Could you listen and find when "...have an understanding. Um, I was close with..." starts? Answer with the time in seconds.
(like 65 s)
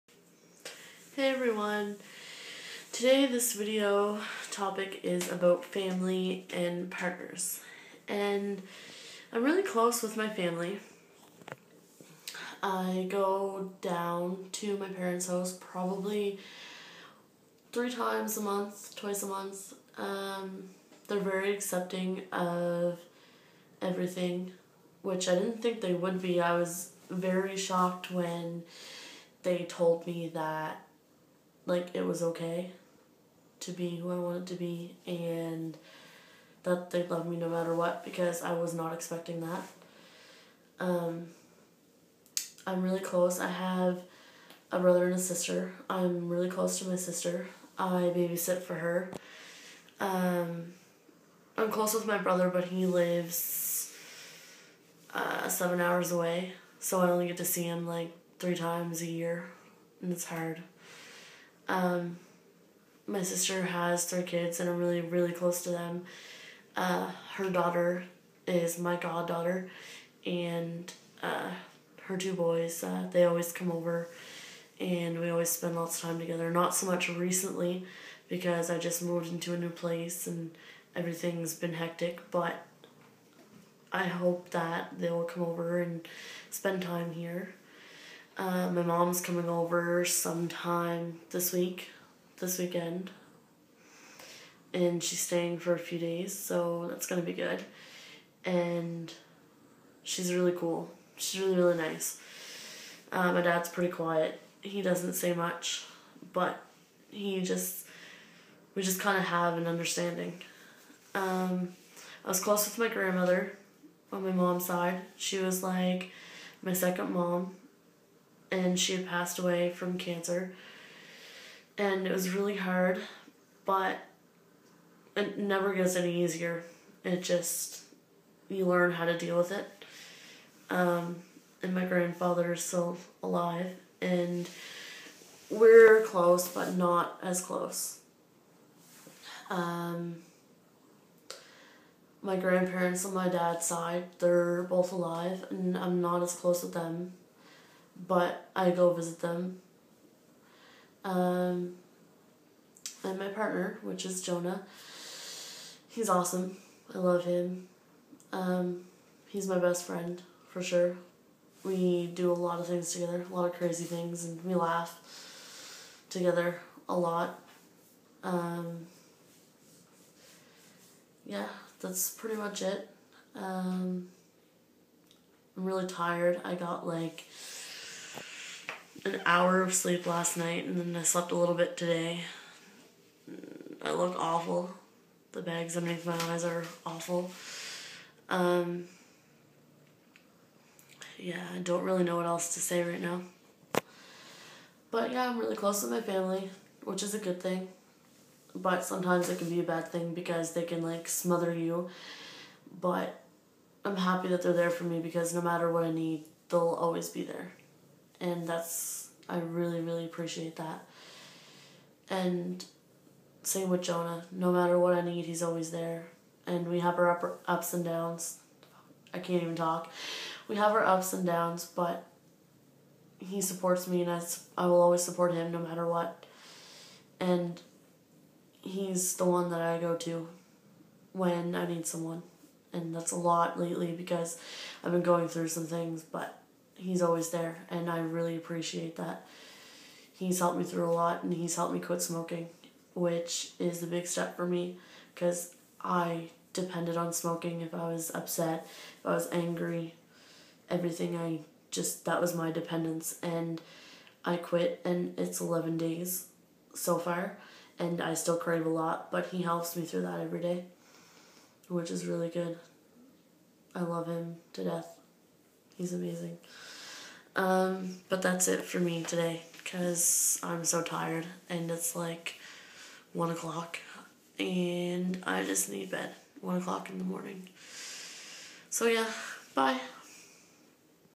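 109 s.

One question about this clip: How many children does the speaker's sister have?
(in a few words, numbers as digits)
3.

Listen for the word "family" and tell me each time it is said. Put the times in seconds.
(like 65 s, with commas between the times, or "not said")
5 s, 10 s, 196 s.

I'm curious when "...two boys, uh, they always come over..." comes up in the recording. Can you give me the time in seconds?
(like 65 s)
72 s.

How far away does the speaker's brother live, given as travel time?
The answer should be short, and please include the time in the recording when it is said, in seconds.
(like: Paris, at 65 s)
7 hours, at 55 s.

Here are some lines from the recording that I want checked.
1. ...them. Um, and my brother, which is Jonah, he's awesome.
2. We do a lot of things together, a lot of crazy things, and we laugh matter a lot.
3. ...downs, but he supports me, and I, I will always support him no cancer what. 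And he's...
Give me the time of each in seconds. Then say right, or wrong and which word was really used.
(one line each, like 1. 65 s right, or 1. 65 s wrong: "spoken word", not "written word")
1. 149 s wrong: "partner", not "brother"
2. 161 s wrong: "together", not "matter"
3. 221 s wrong: "matter", not "cancer".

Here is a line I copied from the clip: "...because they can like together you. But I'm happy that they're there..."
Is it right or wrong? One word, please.
wrong.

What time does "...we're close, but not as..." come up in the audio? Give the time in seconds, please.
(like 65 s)
135 s.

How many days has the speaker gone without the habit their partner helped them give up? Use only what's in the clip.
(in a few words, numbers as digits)
11 days.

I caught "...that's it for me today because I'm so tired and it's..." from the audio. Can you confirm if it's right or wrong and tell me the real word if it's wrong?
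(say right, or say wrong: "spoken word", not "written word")
right.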